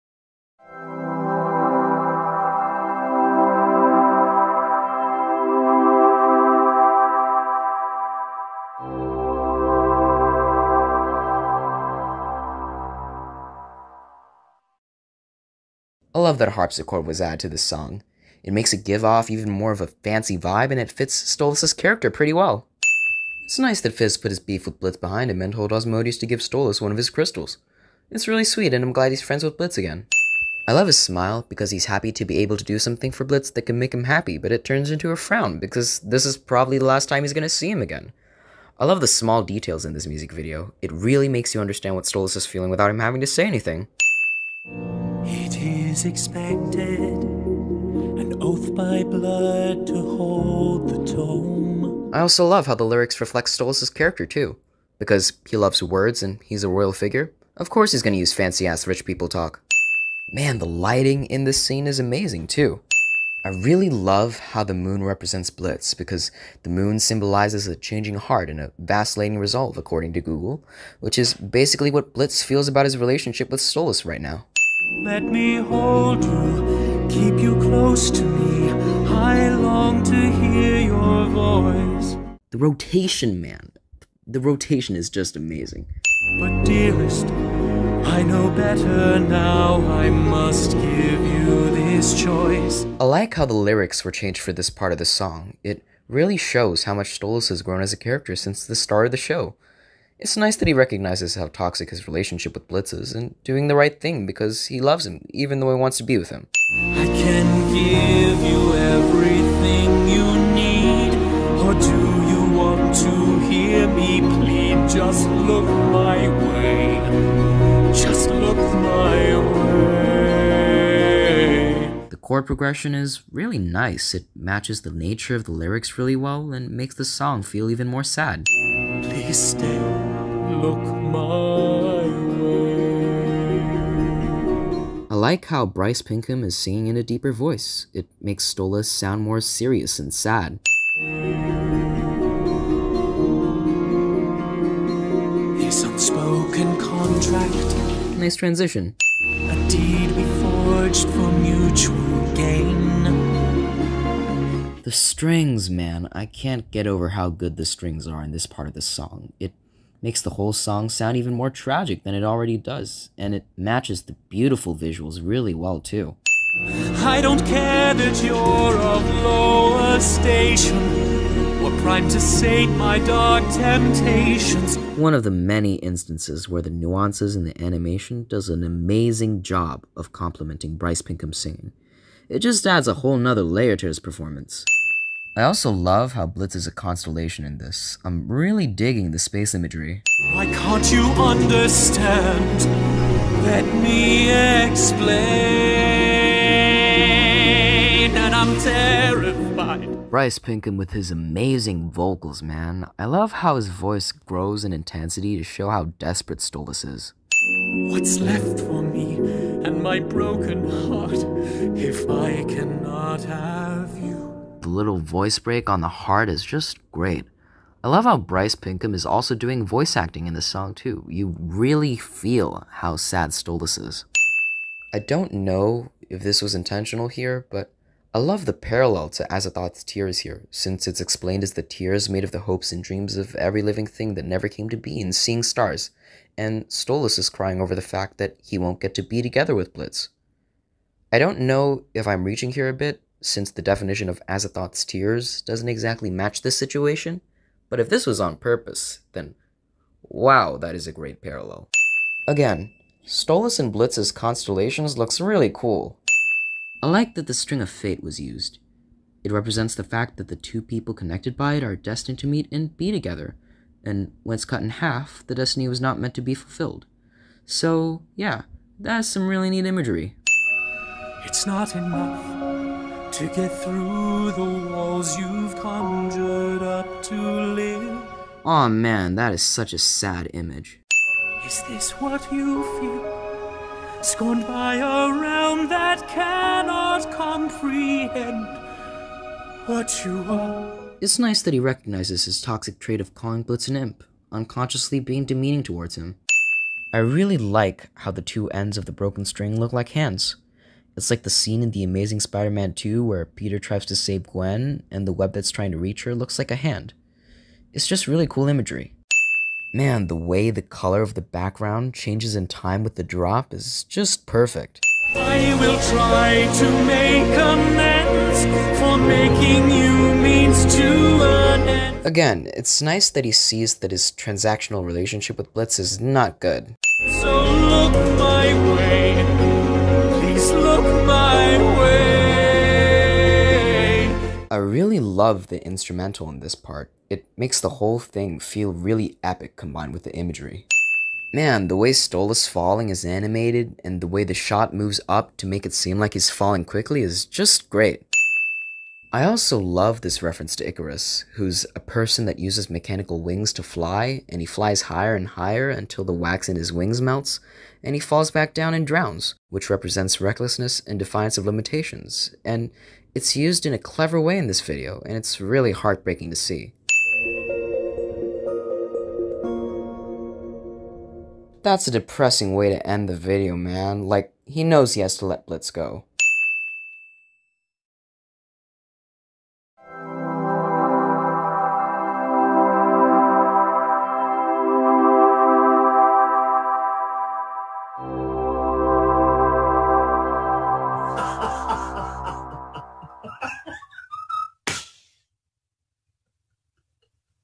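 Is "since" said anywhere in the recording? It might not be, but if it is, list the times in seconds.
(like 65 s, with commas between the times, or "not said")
98 s, 230 s, 243 s.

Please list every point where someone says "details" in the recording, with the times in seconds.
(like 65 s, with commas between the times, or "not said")
39 s.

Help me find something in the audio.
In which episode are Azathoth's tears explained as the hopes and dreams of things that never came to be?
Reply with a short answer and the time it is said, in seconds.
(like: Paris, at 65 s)
Seeing Stars, at 235 s.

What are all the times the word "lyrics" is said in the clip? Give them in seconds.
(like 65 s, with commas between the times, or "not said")
52 s, 93 s, 125 s.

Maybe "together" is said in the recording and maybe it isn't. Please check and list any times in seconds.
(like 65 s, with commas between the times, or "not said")
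239 s, 262 s.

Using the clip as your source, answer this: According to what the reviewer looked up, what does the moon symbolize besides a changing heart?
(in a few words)
a vacillating resolve.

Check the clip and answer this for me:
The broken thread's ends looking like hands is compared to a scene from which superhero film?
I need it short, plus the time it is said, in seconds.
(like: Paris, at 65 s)
The Amazing Spider Man 2, at 301 s.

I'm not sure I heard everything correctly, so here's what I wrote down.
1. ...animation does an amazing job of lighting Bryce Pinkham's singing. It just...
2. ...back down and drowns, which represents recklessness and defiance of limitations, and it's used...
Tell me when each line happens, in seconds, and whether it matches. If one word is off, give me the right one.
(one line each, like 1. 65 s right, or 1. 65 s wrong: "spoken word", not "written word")
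1. 177 s wrong: "complementing", not "lighting"
2. 358 s right.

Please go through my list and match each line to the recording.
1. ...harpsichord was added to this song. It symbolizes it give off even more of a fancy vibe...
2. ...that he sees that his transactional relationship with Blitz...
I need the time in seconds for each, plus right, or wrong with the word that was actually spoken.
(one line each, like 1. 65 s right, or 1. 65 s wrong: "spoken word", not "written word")
1. 16 s wrong: "makes", not "symbolizes"
2. 323 s right.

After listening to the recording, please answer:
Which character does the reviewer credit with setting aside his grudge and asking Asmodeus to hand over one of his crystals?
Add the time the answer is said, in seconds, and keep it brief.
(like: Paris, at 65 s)
Fizz, at 23 s.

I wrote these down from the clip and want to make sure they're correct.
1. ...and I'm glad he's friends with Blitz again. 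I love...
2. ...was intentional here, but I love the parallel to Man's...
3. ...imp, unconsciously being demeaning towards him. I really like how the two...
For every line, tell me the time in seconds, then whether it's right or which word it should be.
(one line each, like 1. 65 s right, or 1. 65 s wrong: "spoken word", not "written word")
1. 28 s right
2. 226 s wrong: "Azathoth", not "Man"
3. 293 s right.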